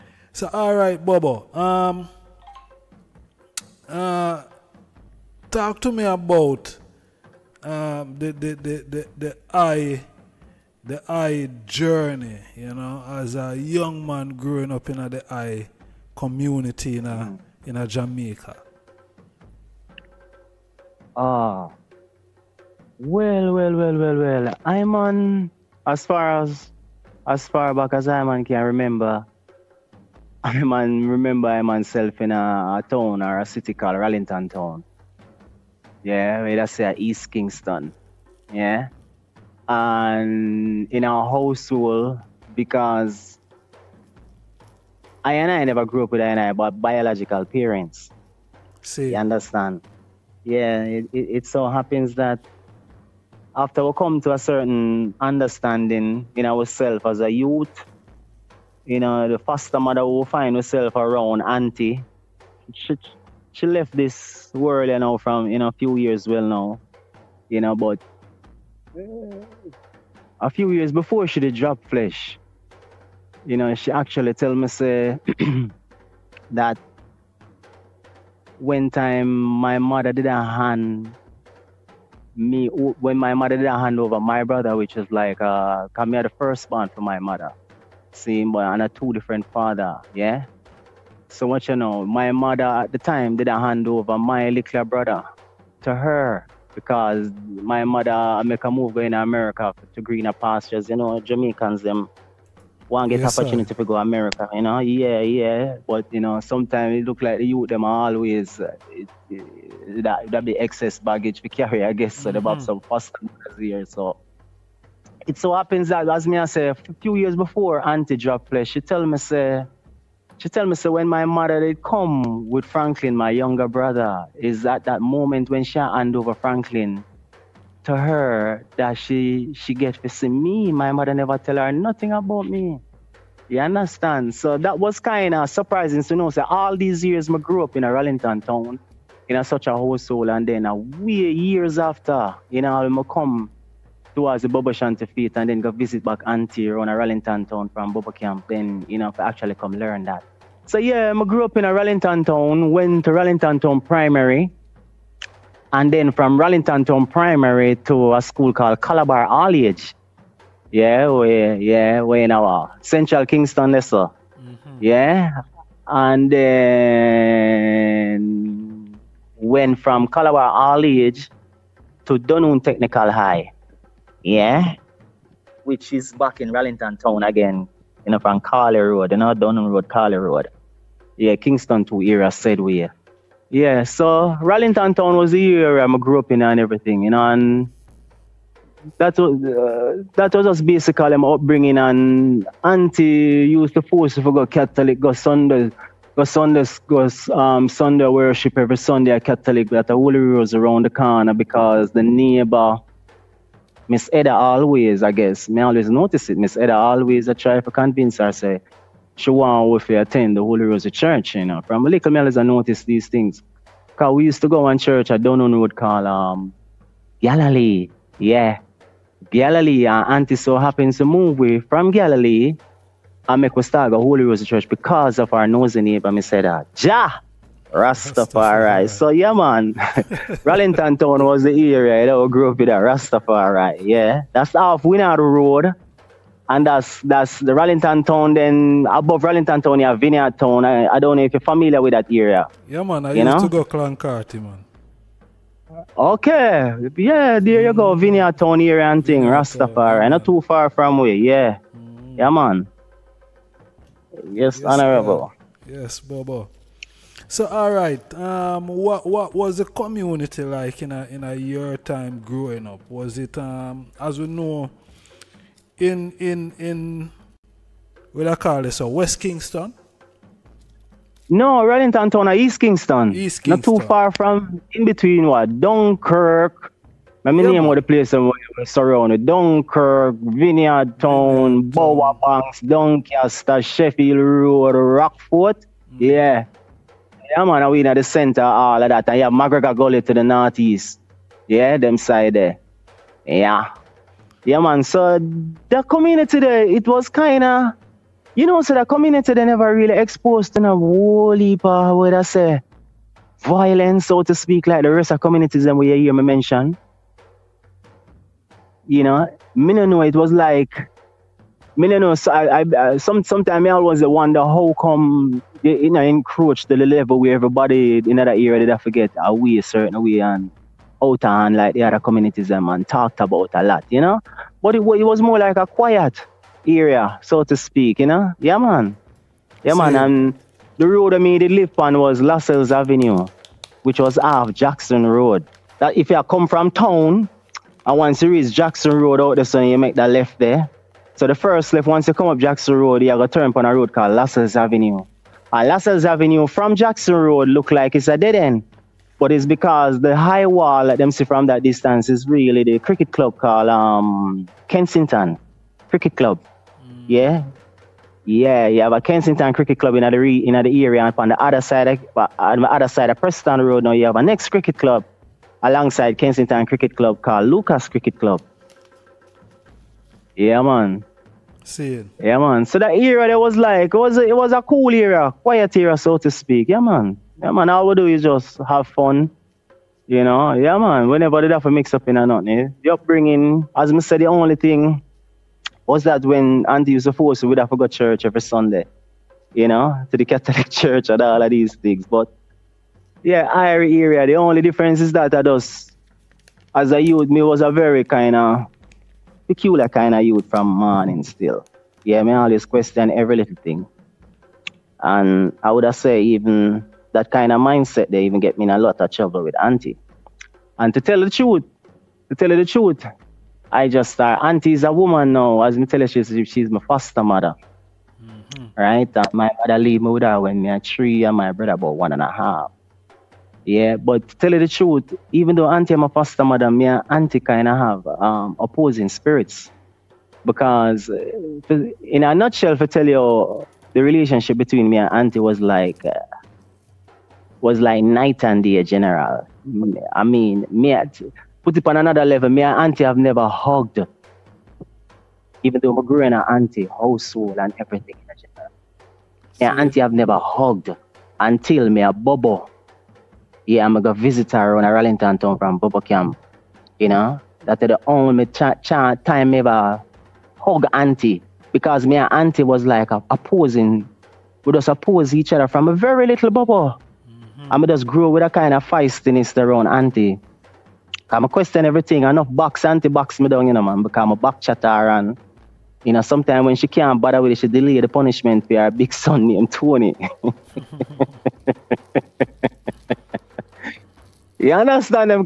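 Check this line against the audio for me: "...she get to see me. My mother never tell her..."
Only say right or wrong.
right.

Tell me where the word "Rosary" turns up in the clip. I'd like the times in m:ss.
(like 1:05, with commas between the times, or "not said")
3:30, 3:44.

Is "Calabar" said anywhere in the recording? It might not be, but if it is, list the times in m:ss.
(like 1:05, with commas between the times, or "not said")
2:38, 2:50.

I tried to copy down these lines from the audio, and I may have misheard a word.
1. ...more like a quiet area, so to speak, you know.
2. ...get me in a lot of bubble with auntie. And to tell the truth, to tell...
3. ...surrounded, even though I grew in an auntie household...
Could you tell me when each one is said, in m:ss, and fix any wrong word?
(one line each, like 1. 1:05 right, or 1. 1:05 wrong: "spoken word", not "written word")
1. 5:25 right
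2. 6:48 wrong: "trouble", not "bubble"
3. 7:23 wrong: "hugged", not "surrounded".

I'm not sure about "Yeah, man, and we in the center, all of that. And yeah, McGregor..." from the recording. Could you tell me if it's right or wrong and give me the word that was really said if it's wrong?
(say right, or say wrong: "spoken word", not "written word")
right.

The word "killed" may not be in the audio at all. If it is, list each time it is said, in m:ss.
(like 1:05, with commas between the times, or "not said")
not said.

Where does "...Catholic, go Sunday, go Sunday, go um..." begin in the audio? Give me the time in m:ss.
3:14.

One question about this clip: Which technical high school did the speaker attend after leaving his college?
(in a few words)
Dunoon Technical High.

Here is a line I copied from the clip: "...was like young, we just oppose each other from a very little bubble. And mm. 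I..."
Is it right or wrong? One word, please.
wrong.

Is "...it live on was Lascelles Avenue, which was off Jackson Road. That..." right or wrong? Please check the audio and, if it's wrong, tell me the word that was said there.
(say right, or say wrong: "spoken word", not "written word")
right.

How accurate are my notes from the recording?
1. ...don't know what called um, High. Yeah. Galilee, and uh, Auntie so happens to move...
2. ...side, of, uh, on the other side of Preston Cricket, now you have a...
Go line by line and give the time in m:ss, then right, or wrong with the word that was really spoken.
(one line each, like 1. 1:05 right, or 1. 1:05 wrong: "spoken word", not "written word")
1. 3:35 wrong: "Galilee", not "High"
2. 6:01 wrong: "Road", not "Cricket".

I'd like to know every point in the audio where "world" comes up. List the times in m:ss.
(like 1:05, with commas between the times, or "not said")
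1:04.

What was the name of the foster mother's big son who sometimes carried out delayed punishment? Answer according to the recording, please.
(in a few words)
Tony.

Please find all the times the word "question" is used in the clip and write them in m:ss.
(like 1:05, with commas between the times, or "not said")
6:42, 7:51.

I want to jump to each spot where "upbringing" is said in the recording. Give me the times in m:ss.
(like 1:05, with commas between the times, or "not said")
3:11, 6:22.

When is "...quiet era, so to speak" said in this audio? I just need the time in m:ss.
6:15.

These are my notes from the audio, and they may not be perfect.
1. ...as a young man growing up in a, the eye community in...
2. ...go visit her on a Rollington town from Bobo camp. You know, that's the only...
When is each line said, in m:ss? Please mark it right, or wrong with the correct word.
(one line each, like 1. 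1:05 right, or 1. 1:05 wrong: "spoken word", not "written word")
1. 0:13 right
2. 7:34 right.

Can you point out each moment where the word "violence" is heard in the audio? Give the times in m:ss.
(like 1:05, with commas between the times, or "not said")
5:03.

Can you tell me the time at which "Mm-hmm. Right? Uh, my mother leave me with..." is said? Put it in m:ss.
6:58.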